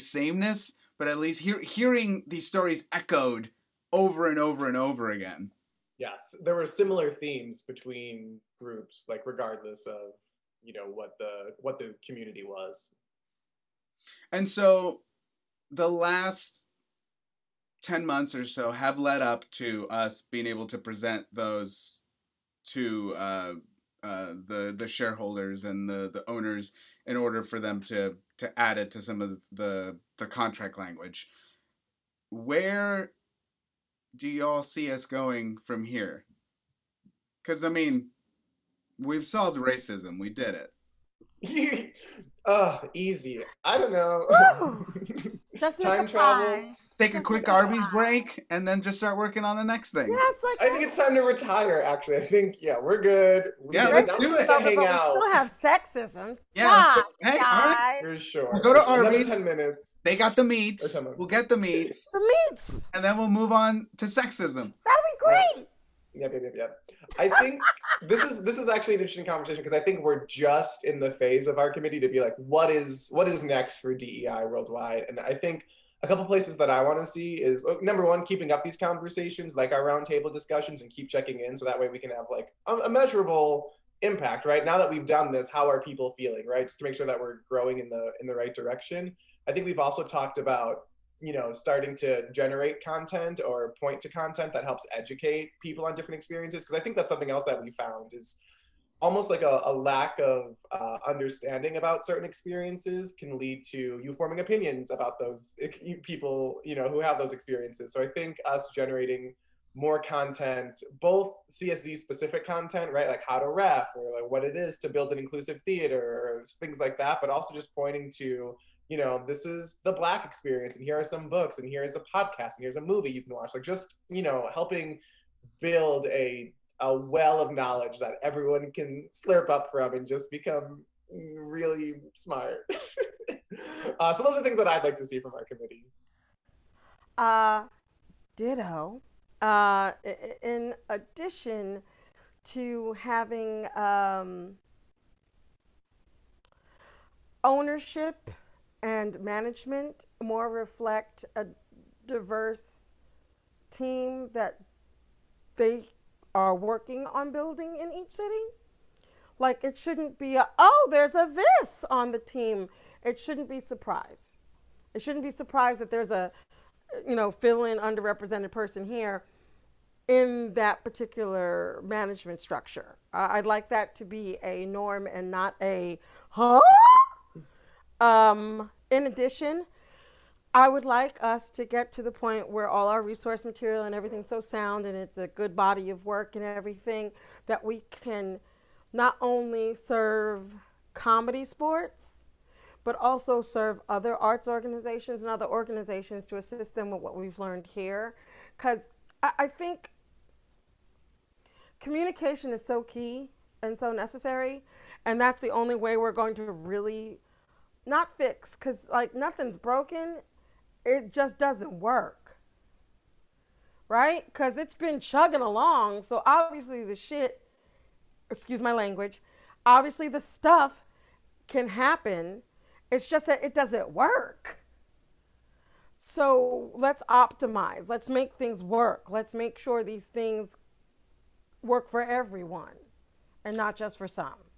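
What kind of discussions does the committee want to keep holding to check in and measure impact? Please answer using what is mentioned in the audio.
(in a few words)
Roundtable discussions.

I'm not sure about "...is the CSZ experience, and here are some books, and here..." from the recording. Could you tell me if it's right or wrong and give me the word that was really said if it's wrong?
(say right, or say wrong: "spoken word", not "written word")
wrong: "Black", not "CSZ".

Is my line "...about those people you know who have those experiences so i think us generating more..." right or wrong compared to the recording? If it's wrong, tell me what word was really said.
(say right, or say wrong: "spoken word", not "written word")
right.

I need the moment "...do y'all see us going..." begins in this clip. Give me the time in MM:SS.
00:34.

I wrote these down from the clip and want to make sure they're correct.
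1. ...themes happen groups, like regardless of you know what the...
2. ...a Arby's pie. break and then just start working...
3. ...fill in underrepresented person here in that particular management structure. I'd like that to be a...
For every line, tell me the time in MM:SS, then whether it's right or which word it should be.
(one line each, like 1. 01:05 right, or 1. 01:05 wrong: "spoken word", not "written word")
1. 00:07 wrong: "between", not "happen"
2. 00:47 right
3. 02:47 right.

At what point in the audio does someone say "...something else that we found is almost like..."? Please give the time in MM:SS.
01:37.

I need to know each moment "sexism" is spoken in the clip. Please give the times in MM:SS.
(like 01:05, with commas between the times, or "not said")
00:55, 01:04.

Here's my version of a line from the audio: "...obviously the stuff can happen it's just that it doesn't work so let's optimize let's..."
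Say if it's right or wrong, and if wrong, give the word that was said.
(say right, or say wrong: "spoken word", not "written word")
right.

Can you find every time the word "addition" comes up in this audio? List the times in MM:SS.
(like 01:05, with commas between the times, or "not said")
02:20, 02:59.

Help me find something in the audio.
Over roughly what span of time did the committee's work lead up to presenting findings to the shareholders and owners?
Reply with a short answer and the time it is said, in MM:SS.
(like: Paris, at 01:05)
10 months, at 00:17.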